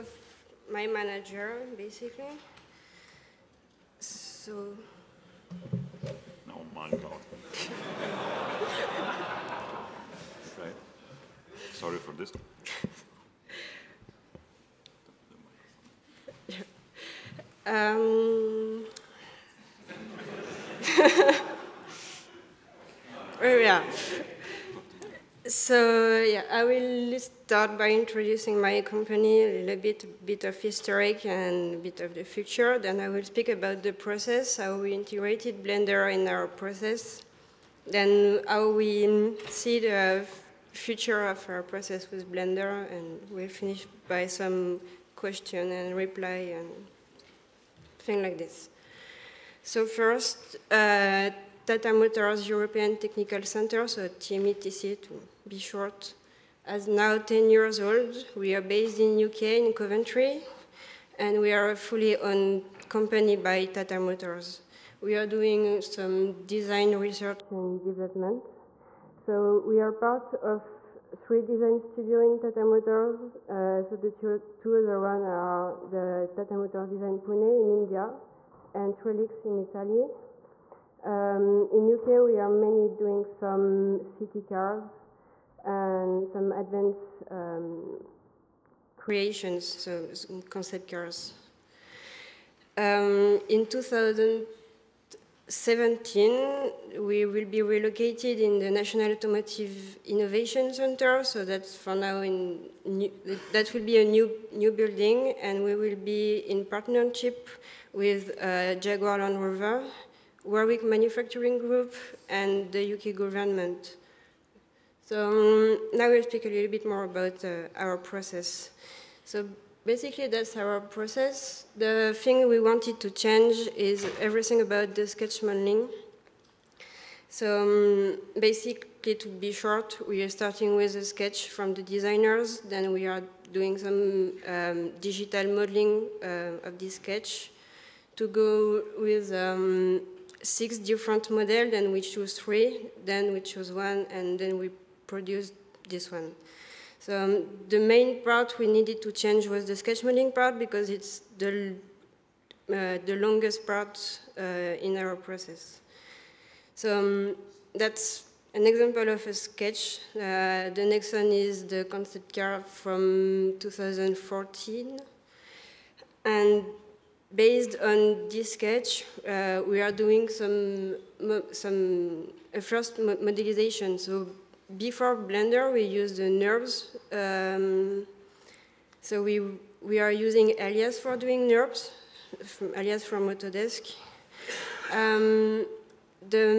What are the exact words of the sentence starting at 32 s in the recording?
Then I will speak about the process, how we integrated Blender in our process.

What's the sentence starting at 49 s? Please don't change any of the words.
So first, uh, Tata Motors European Technical Center, so TMETC to be short, is now 10 years old.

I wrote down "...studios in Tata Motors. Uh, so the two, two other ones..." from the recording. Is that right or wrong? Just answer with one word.
right.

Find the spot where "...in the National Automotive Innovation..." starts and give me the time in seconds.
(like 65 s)
98 s.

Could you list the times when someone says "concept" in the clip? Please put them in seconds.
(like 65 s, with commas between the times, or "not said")
90 s, 161 s.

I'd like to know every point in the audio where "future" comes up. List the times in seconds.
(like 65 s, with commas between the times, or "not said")
32 s, 40 s.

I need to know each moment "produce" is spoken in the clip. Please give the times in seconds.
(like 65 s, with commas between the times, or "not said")
145 s.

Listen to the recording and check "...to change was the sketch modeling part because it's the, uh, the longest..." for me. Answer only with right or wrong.
right.